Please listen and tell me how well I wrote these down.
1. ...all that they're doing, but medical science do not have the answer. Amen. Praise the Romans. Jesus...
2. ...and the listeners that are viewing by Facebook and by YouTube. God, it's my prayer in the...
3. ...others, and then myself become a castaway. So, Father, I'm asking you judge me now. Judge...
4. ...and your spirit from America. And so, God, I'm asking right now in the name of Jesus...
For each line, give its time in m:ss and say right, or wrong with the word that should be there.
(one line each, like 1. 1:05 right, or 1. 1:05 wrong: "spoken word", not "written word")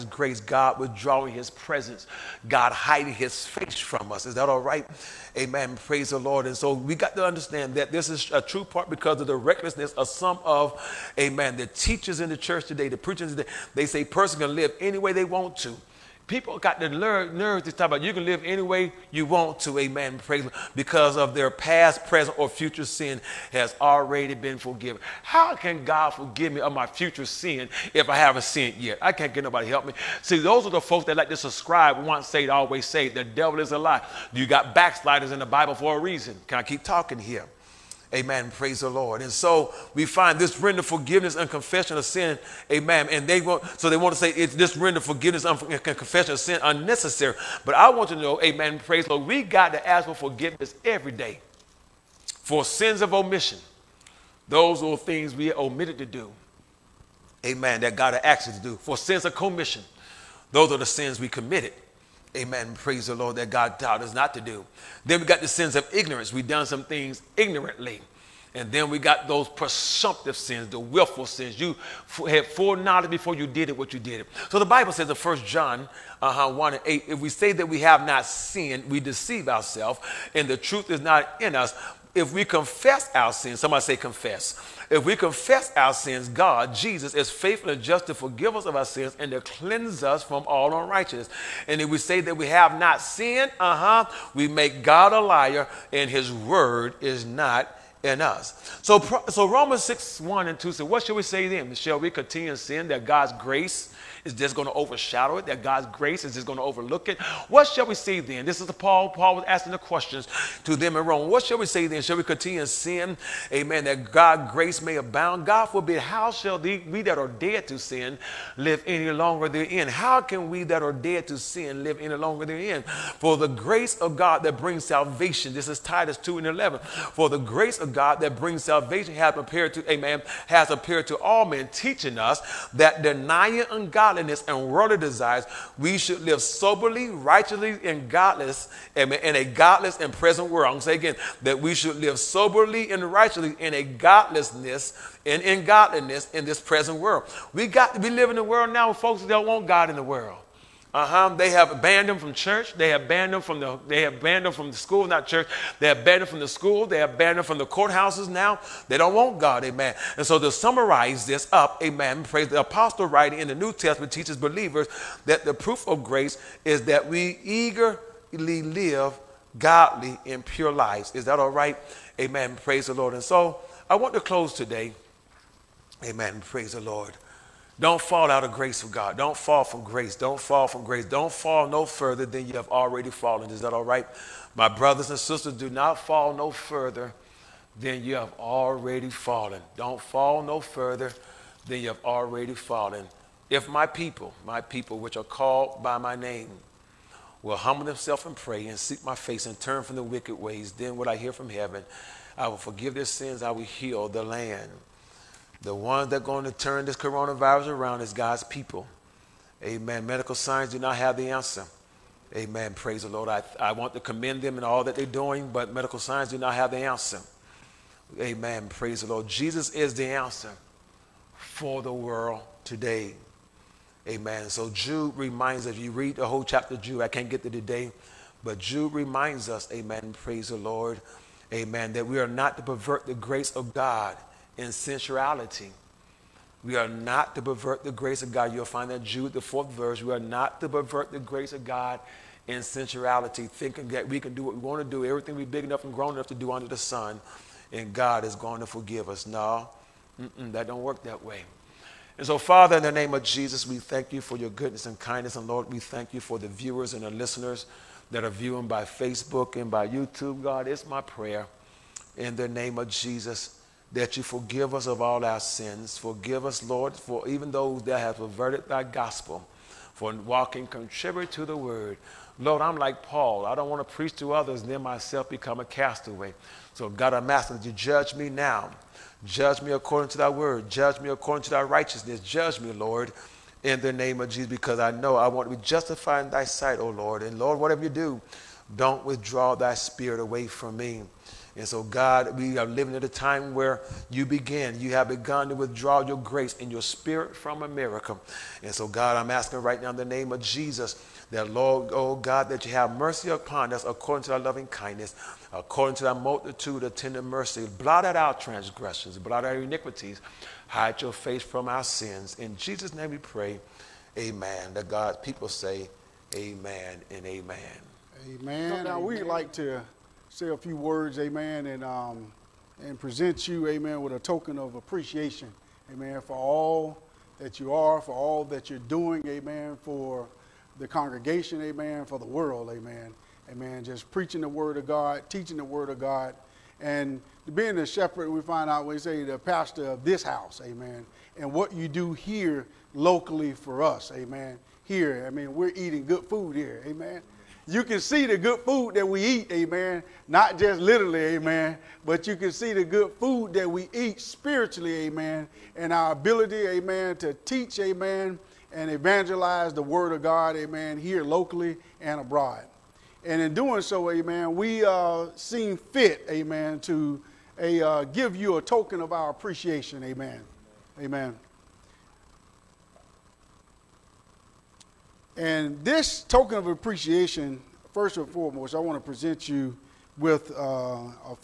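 1. 3:34 wrong: "Lord", not "Romans"
2. 4:16 right
3. 4:34 wrong: "God", not "Father"
4. 4:56 right.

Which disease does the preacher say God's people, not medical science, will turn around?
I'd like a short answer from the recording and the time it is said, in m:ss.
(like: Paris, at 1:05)
Coronavirus, at 3:26.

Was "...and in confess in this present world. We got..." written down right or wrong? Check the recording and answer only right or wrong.
wrong.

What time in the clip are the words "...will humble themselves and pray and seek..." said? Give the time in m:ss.
3:17.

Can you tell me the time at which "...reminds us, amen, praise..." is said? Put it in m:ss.
3:48.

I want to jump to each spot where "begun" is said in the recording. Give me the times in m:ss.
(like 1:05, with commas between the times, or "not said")
4:55.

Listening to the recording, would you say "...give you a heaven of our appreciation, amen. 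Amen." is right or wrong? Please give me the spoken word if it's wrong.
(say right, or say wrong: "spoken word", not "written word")
wrong: "token", not "heaven".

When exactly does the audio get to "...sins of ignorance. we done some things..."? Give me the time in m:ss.
1:05.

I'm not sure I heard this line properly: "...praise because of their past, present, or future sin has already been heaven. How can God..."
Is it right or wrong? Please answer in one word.
wrong.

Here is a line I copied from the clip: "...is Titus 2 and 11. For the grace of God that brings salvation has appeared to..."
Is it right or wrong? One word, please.
right.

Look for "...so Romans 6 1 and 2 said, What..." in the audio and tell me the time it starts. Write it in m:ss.
1:39.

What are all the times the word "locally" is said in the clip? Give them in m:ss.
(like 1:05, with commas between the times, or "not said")
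5:42, 6:01.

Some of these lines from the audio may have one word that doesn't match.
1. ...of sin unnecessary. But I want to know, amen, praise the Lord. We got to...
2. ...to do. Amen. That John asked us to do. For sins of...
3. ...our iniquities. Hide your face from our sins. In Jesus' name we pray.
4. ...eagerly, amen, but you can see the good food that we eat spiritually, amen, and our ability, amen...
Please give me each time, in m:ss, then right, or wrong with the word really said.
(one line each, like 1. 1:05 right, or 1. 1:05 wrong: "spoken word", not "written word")
1. 0:46 right
2. 0:55 wrong: "God", not "John"
3. 5:09 right
4. 5:50 wrong: "literally", not "eagerly".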